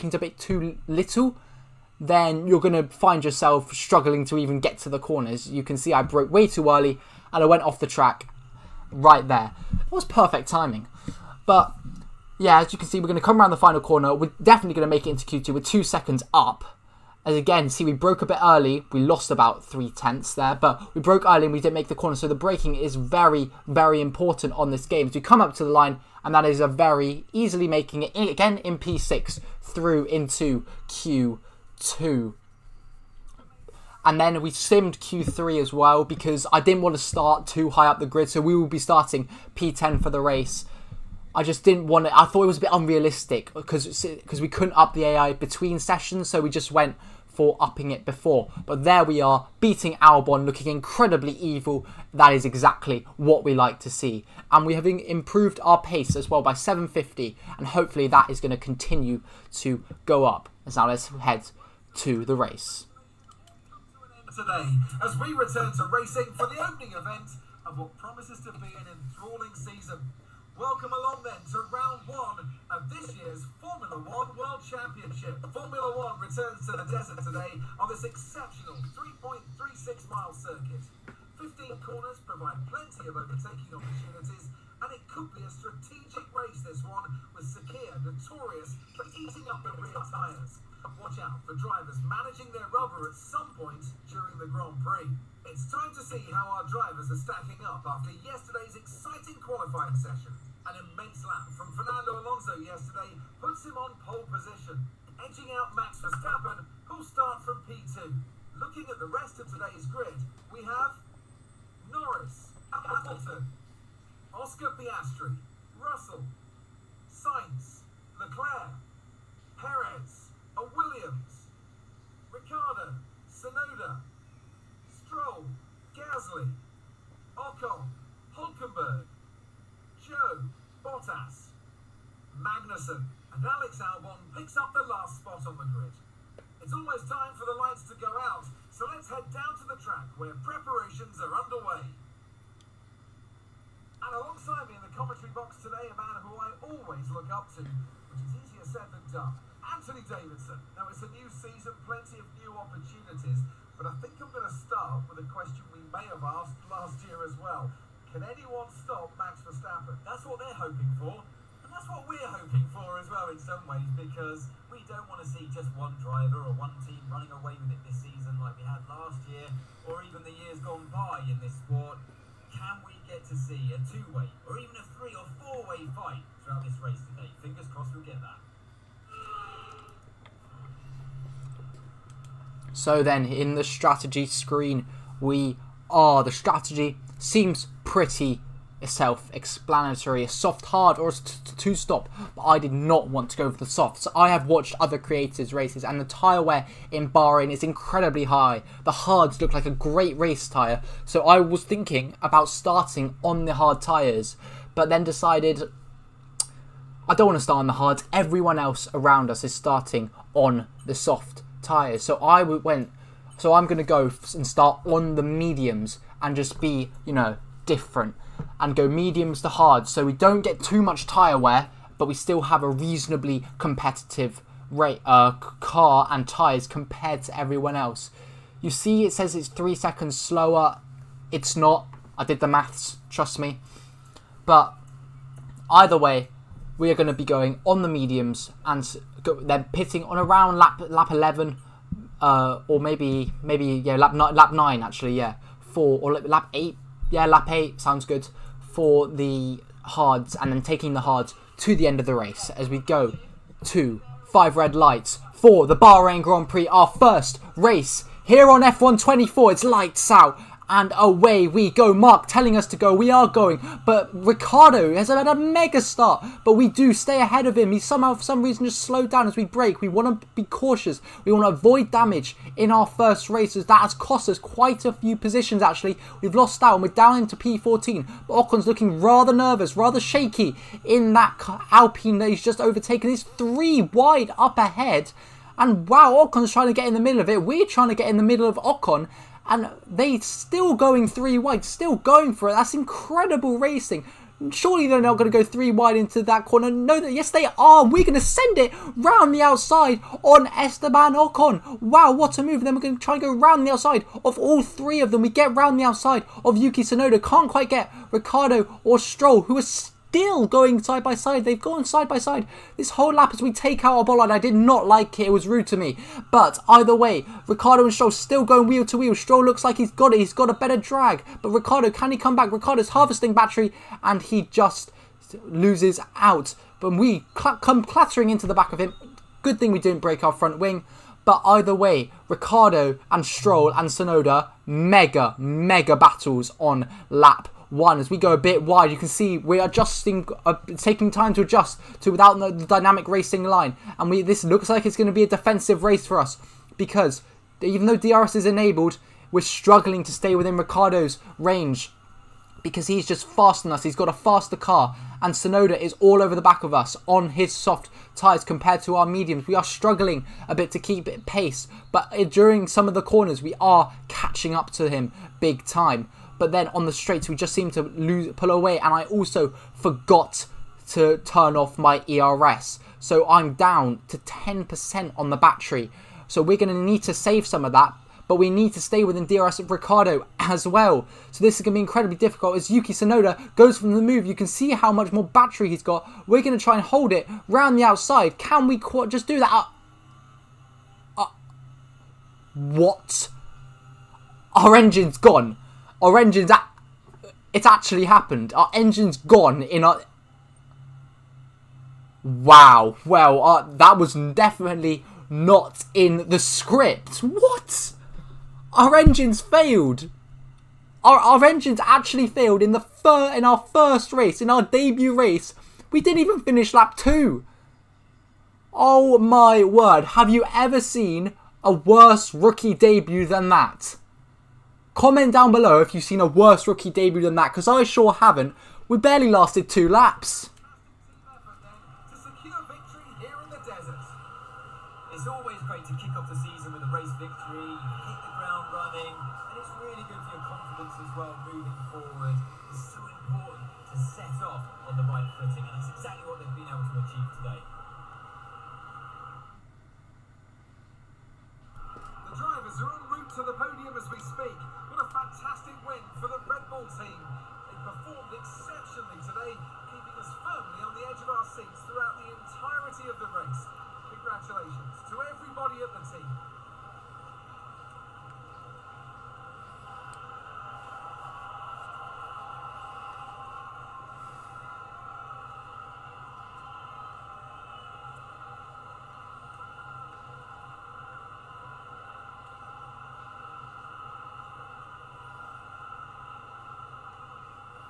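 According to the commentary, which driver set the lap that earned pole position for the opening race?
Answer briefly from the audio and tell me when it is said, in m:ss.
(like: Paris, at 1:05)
Fernando Alonso, at 1:41.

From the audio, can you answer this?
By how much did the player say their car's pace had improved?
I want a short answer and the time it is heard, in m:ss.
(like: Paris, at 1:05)
750, at 0:56.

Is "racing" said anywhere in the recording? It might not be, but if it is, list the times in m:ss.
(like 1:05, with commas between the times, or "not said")
1:05, 4:53, 5:43.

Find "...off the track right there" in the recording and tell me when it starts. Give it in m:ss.
0:07.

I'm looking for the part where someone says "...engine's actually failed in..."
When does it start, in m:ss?
6:51.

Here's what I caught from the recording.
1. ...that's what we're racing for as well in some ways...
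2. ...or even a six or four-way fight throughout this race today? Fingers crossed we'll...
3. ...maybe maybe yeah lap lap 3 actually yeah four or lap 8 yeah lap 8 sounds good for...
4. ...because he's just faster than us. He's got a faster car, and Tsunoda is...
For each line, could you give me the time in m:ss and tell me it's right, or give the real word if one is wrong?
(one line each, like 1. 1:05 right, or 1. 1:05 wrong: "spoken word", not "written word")
1. 2:41 wrong: "hoping", not "racing"
2. 2:54 wrong: "three", not "six"
3. 4:02 wrong: "9", not "3"
4. 5:52 right.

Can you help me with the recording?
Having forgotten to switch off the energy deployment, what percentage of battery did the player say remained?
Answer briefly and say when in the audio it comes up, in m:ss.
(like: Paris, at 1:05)
10%, at 6:14.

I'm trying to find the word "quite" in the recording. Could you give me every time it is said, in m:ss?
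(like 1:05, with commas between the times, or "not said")
4:34, 5:07.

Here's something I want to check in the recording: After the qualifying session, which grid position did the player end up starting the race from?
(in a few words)
P10.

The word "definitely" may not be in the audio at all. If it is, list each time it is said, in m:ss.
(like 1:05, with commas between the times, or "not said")
0:14, 6:44.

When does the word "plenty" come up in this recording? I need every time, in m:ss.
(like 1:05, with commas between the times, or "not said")
1:22, 2:31.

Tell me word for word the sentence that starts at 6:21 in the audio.
So this is going to be incredibly difficult as Yuki Tsunoda goes from the move.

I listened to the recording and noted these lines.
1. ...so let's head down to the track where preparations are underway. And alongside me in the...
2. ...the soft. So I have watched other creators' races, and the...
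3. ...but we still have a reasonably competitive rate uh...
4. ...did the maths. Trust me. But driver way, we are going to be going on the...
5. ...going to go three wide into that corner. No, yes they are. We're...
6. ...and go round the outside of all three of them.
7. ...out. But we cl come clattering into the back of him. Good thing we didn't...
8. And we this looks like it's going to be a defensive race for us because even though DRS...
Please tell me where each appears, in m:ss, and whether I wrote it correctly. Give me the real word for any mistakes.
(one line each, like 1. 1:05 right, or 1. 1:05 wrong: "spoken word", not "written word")
1. 2:18 right
2. 3:13 right
3. 3:41 right
4. 3:52 wrong: "either", not "driver"
5. 4:55 right
6. 5:03 right
7. 5:26 right
8. 5:43 right.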